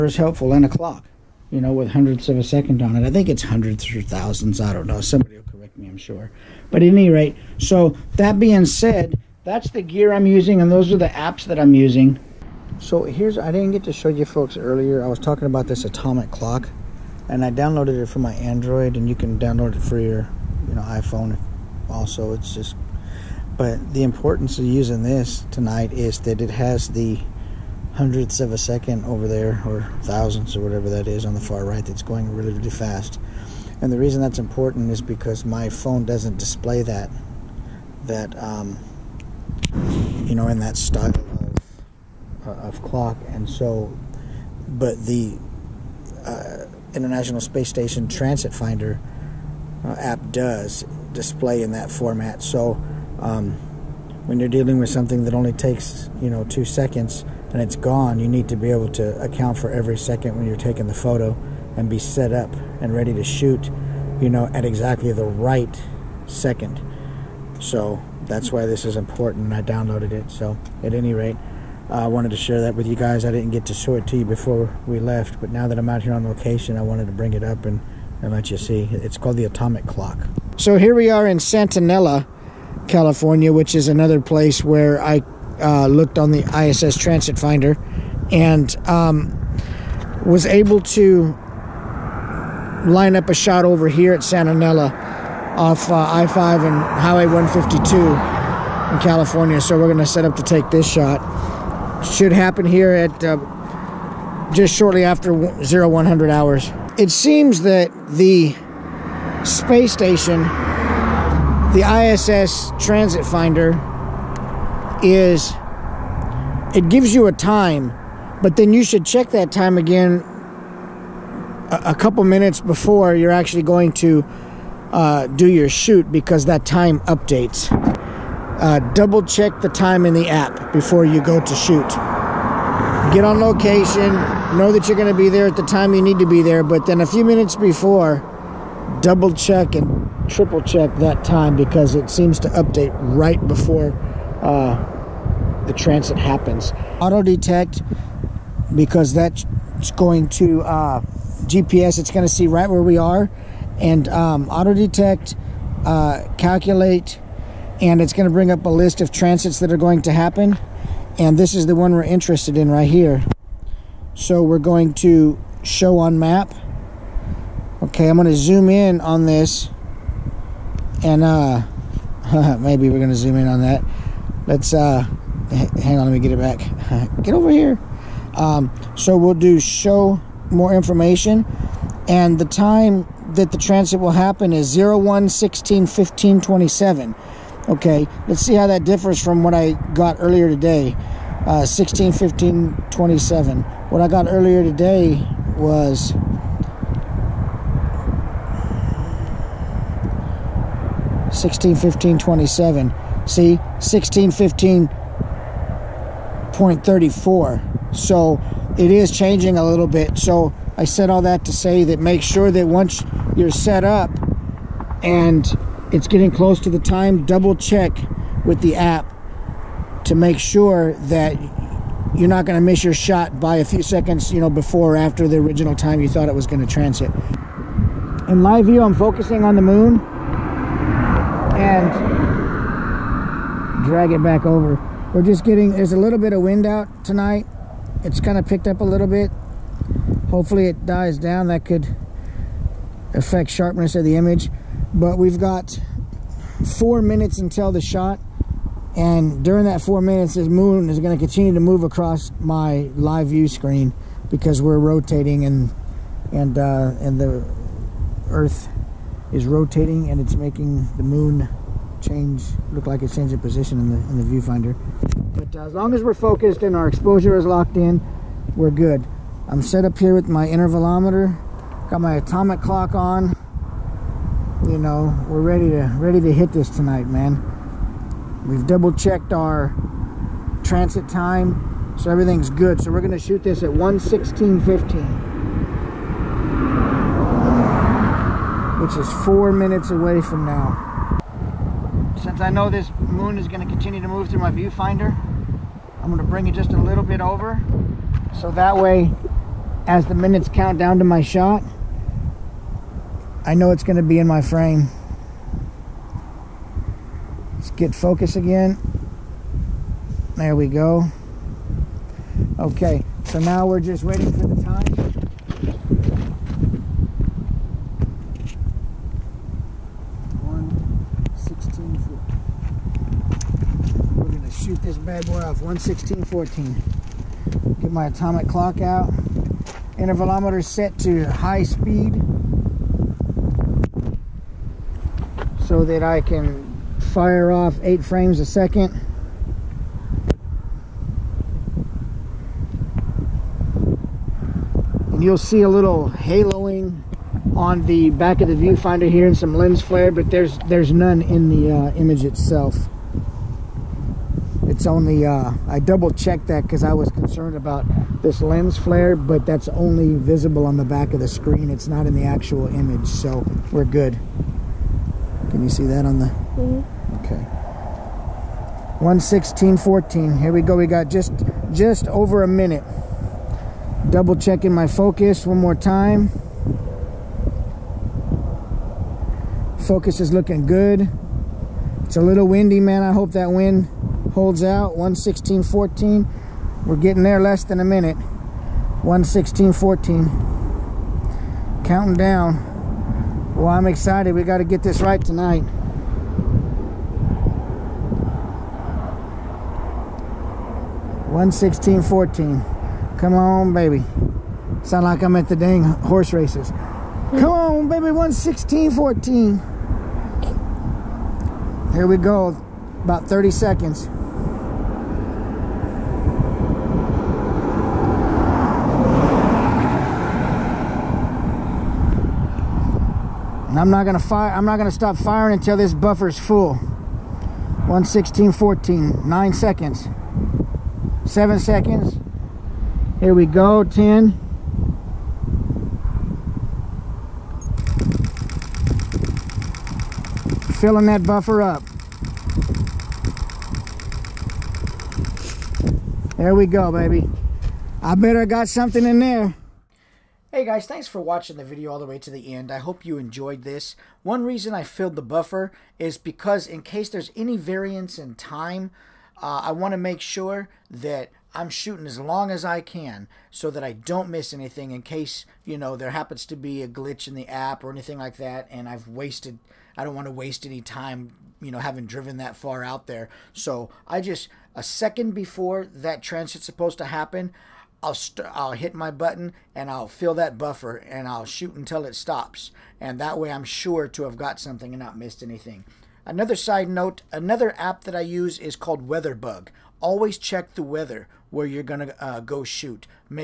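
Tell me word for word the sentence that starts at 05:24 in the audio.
shoot this bad boy off 116.14.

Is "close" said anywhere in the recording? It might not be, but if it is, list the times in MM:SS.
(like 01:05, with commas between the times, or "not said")
03:36.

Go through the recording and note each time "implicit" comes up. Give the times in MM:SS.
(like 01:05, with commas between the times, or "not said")
not said.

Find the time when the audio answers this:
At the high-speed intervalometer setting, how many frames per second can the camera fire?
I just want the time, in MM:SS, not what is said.
05:37.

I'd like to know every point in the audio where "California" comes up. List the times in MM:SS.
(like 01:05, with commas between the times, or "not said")
01:22, 01:39.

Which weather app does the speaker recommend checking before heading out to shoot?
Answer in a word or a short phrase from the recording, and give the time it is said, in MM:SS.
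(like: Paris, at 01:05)
Weatherbug, at 08:09.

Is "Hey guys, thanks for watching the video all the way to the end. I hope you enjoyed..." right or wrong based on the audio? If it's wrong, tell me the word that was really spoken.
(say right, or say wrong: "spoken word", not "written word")
right.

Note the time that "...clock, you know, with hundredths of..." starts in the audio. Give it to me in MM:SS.
00:00.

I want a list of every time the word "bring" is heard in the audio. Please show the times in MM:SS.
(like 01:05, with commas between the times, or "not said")
01:17, 02:38, 04:56.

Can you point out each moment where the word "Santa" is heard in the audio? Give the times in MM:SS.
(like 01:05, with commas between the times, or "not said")
01:21, 01:34.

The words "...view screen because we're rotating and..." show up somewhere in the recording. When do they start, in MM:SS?
04:13.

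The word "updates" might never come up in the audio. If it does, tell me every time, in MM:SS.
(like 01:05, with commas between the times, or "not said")
02:07, 02:22.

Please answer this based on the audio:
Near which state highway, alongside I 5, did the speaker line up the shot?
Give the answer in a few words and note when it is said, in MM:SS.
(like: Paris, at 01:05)
Highway 152, at 01:36.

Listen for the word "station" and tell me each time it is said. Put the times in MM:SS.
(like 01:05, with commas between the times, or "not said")
00:47, 01:49.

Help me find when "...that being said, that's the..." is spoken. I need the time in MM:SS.
00:08.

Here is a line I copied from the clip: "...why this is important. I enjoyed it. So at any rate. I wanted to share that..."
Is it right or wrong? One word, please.
wrong.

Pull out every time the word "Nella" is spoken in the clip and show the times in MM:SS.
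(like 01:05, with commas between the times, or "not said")
01:21, 01:34.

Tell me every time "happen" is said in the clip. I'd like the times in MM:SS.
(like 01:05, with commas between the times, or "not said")
01:42, 02:26, 02:40, 03:04, 07:46, 07:57.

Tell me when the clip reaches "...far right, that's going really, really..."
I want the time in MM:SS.
00:31.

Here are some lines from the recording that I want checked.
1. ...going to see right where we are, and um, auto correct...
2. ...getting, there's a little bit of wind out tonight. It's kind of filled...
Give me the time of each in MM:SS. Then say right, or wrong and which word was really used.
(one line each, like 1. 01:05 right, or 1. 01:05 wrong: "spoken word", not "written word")
1. 02:32 wrong: "detect", not "correct"
2. 03:55 wrong: "picked", not "filled".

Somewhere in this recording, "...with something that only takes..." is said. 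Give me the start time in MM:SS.
00:54.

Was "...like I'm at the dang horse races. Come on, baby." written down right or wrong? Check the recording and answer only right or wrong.
right.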